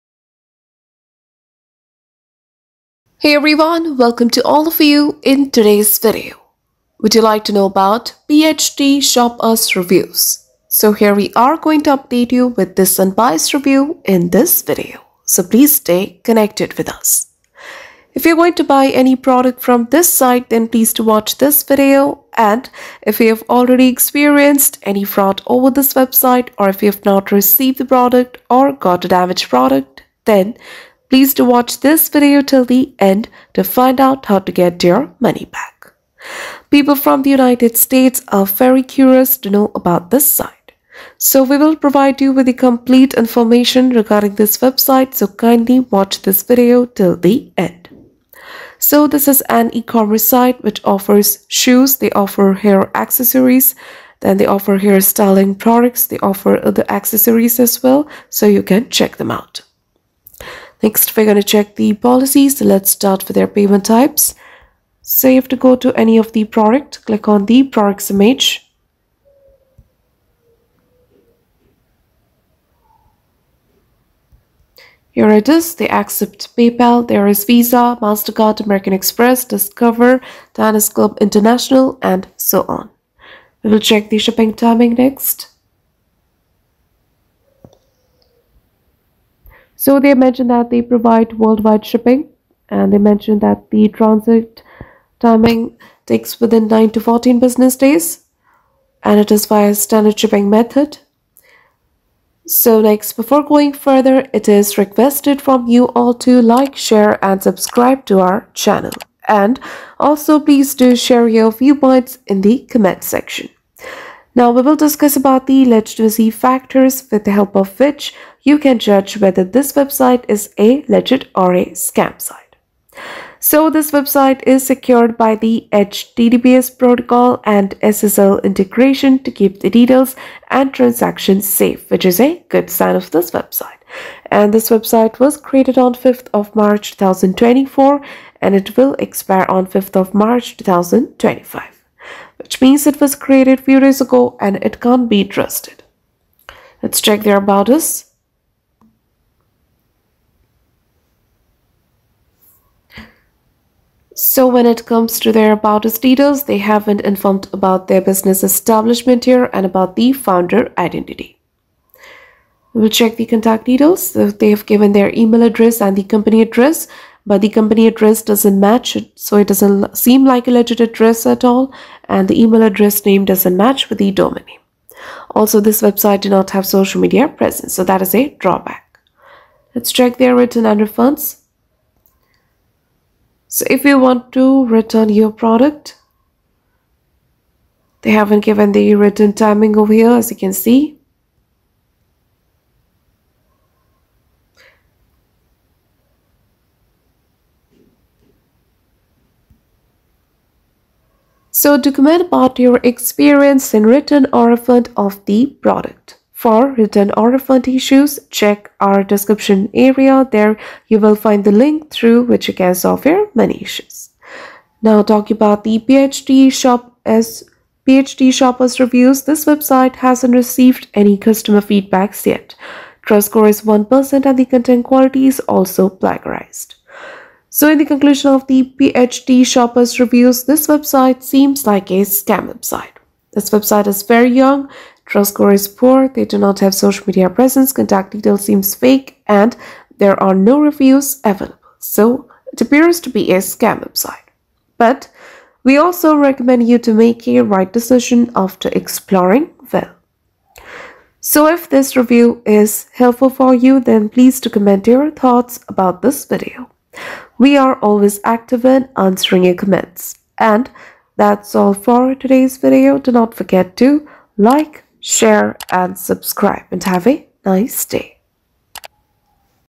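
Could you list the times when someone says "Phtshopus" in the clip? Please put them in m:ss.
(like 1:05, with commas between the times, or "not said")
0:08, 3:35, 3:48.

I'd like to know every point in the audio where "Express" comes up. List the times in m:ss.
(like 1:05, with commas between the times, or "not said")
1:18.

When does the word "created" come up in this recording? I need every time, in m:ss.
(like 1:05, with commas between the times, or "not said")
2:15, 2:23.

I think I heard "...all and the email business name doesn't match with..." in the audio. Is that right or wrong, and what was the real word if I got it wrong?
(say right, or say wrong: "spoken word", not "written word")
wrong: "address", not "business".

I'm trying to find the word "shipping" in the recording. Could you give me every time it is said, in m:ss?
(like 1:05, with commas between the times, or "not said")
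1:24, 1:31, 1:40.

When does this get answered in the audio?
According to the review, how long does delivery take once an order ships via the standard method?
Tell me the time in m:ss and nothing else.
1:36.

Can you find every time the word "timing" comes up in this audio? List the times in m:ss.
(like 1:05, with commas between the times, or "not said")
1:24, 1:35, 3:09.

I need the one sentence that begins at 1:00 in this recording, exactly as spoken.
Next, we're going to check the policies.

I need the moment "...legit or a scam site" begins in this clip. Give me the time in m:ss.
2:00.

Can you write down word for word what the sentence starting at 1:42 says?
So next, before going further, it is requested from you all to like, share and subscribe to our channel.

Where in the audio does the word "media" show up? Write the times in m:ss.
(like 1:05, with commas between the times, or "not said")
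2:57, 3:57.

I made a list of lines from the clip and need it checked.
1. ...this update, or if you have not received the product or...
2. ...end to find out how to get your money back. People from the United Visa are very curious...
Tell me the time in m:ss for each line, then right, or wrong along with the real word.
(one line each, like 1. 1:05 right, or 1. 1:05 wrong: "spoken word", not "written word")
1. 0:25 wrong: "website", not "update"
2. 0:32 wrong: "States", not "Visa".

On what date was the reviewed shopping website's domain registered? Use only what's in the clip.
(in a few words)
5 March 2024.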